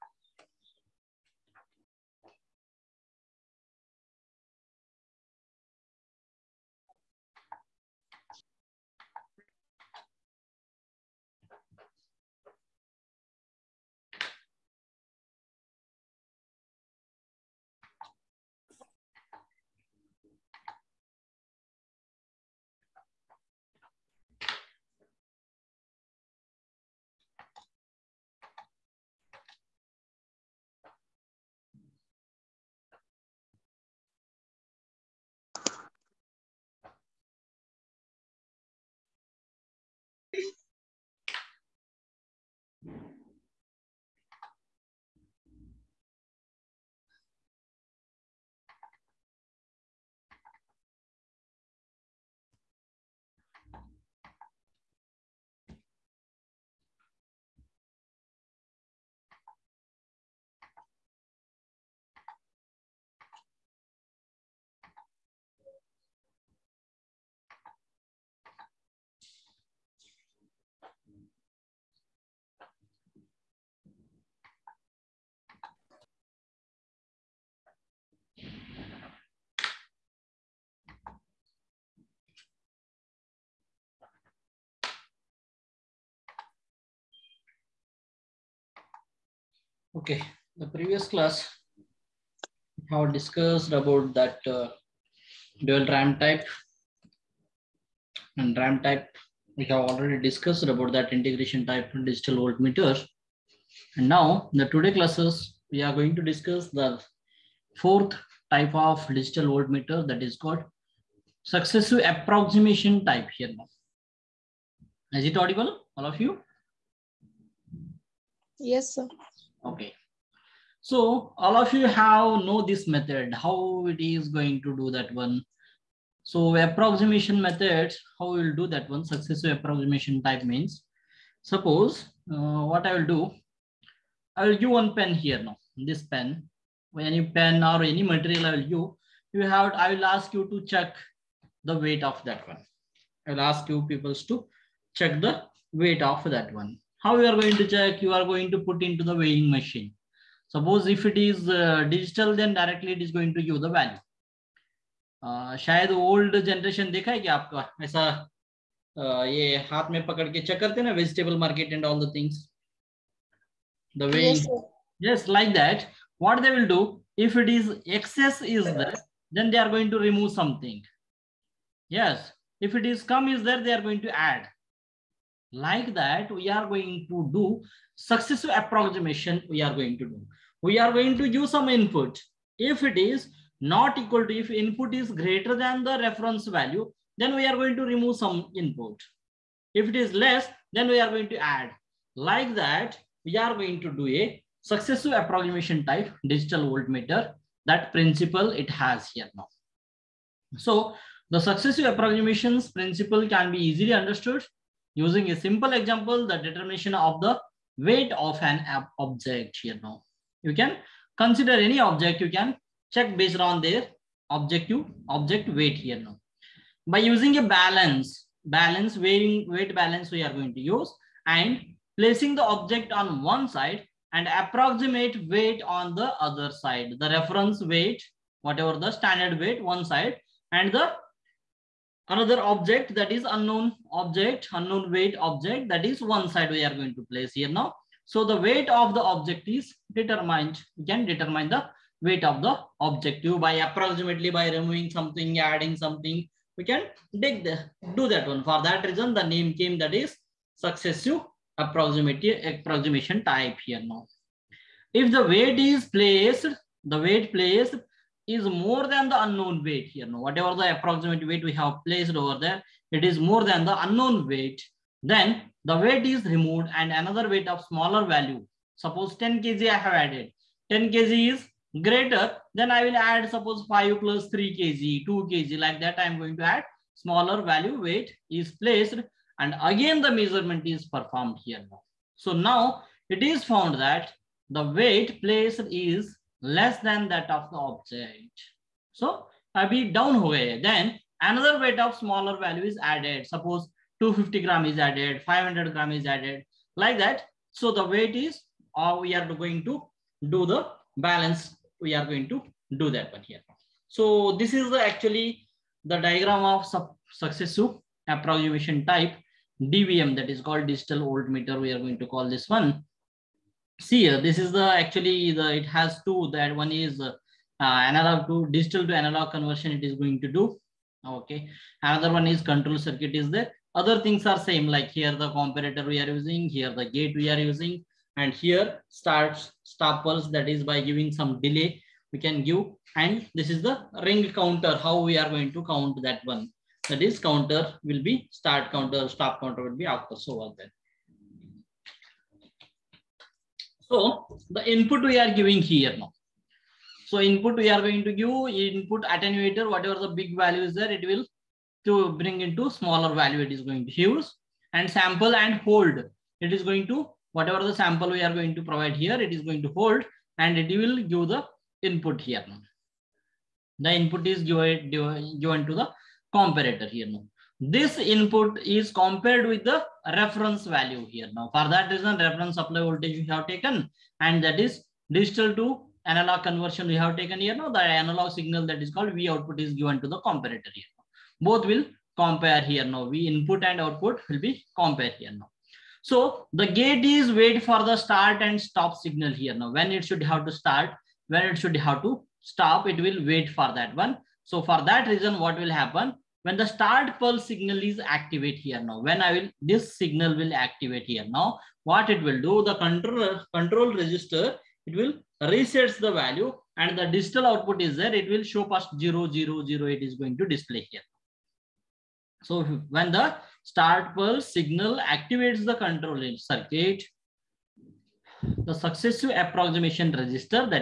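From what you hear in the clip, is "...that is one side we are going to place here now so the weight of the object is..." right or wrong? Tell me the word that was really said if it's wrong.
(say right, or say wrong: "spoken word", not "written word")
right.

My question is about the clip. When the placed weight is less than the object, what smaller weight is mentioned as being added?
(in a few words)
250 gram.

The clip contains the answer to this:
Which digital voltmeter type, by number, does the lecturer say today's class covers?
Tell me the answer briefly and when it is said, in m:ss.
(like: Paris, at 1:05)
Fourth, at 1:47.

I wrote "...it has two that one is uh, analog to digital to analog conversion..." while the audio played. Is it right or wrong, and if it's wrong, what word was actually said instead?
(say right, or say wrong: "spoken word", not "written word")
right.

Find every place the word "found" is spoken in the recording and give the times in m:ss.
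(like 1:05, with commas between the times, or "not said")
4:43.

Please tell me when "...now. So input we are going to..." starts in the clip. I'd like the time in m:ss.
5:45.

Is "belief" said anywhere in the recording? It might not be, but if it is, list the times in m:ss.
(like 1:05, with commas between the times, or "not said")
not said.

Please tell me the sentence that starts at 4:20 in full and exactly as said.
Now, whatever the approximate weight we have placed over there, it is more than the unknown weight.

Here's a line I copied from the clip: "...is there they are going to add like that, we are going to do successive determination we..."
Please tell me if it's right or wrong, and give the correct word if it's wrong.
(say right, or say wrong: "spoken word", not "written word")
wrong: "approximation", not "determination".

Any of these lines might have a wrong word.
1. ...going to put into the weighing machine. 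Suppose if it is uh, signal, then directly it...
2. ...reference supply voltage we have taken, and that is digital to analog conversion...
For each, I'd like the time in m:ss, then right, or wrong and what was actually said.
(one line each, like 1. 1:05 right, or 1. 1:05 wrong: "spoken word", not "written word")
1. 2:28 wrong: "digital", not "signal"
2. 6:12 right.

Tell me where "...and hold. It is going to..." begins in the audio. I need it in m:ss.
5:55.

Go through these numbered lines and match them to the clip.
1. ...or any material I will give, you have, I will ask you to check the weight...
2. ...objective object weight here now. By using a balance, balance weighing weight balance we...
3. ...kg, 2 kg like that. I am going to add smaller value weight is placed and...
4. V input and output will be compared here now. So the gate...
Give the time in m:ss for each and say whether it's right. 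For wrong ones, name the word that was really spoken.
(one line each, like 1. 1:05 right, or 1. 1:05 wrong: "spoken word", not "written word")
1. 2:17 right
2. 3:34 right
3. 4:34 right
4. 6:23 right.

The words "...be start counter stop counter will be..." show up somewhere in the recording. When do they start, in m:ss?
5:38.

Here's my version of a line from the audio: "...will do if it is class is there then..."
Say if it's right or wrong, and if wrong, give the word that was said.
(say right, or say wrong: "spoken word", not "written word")
wrong: "excess", not "class".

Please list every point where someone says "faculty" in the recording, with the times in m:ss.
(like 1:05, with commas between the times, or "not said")
not said.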